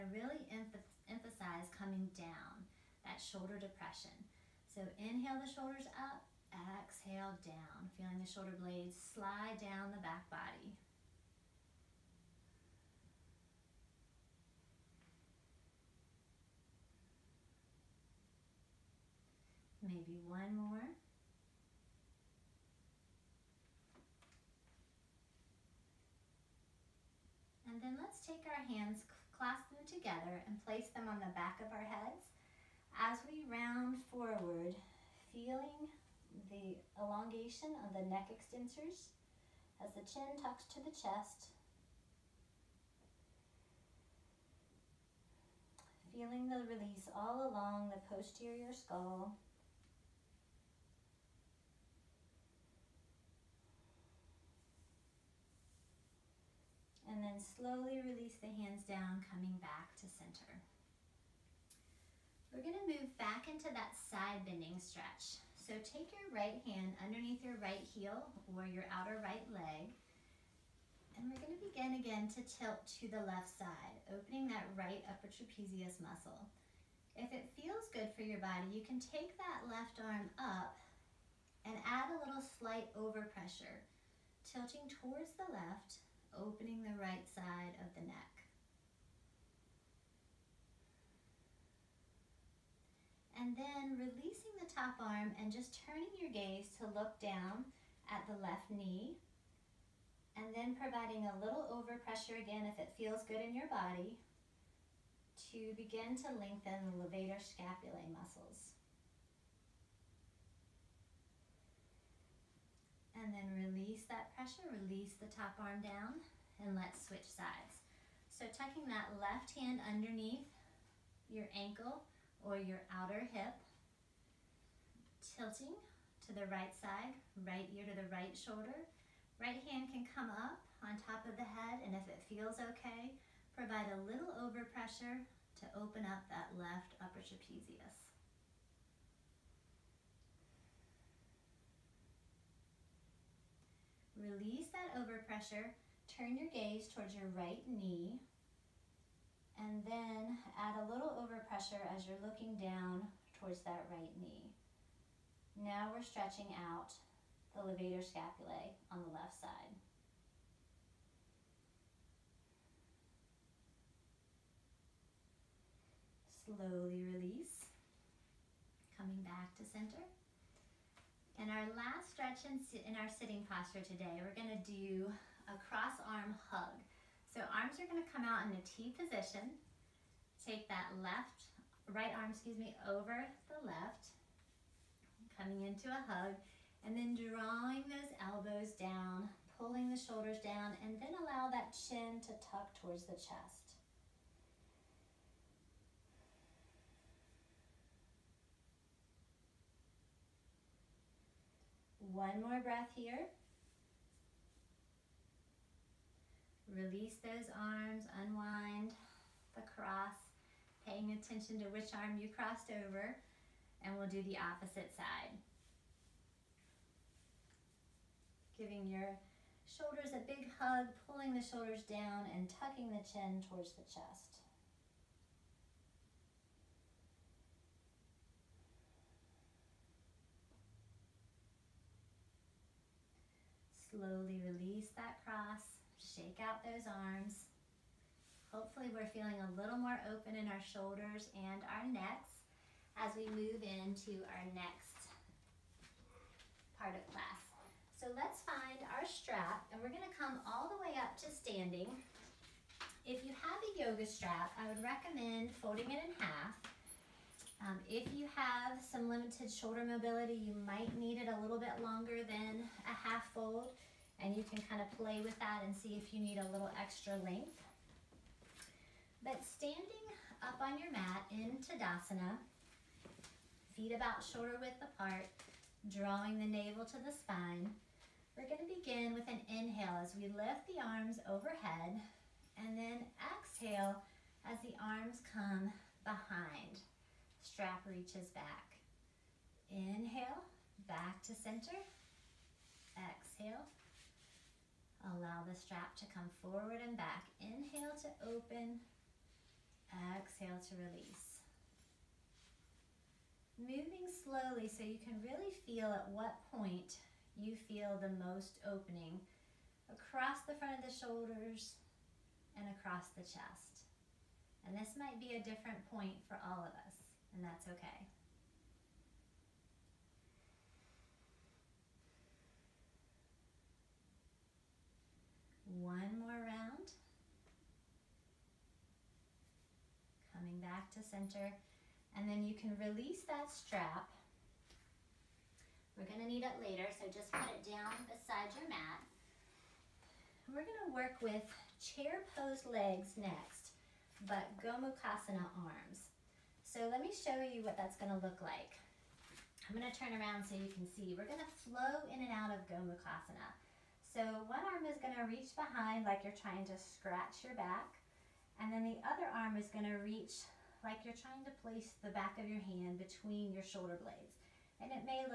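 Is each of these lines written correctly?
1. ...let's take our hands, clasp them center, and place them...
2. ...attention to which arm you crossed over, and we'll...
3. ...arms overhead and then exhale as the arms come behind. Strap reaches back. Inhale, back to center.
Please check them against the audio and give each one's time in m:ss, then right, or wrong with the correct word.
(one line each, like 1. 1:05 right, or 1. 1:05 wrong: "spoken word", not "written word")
1. 0:28 wrong: "together", not "center"
2. 3:31 right
3. 4:40 right.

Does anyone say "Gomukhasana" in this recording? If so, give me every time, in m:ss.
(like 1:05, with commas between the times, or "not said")
5:44, 5:52.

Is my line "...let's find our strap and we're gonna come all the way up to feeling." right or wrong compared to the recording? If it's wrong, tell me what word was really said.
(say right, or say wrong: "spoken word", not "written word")
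wrong: "standing", not "feeling".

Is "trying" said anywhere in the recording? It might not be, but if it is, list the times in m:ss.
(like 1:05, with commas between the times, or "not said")
5:56, 6:01.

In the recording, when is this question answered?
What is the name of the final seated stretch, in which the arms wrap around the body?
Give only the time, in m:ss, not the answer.
2:55.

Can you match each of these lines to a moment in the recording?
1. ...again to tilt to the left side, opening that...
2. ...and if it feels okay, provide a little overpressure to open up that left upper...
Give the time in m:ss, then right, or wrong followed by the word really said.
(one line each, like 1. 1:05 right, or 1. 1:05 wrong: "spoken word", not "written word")
1. 1:11 right
2. 2:11 right.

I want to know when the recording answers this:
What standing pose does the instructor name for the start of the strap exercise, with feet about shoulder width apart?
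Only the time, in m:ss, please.
4:31.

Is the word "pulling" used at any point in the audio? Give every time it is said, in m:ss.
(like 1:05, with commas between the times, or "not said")
3:09, 3:41.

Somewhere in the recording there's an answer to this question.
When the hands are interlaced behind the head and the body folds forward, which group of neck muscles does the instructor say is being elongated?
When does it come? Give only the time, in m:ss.
0:38.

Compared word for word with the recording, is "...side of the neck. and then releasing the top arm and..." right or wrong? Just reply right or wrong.
right.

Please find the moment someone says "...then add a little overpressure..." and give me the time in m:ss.
2:29.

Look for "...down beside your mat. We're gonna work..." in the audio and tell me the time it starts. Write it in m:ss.
5:37.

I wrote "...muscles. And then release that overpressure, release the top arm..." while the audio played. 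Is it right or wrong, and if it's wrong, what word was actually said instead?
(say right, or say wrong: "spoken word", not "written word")
wrong: "pressure", not "overpressure".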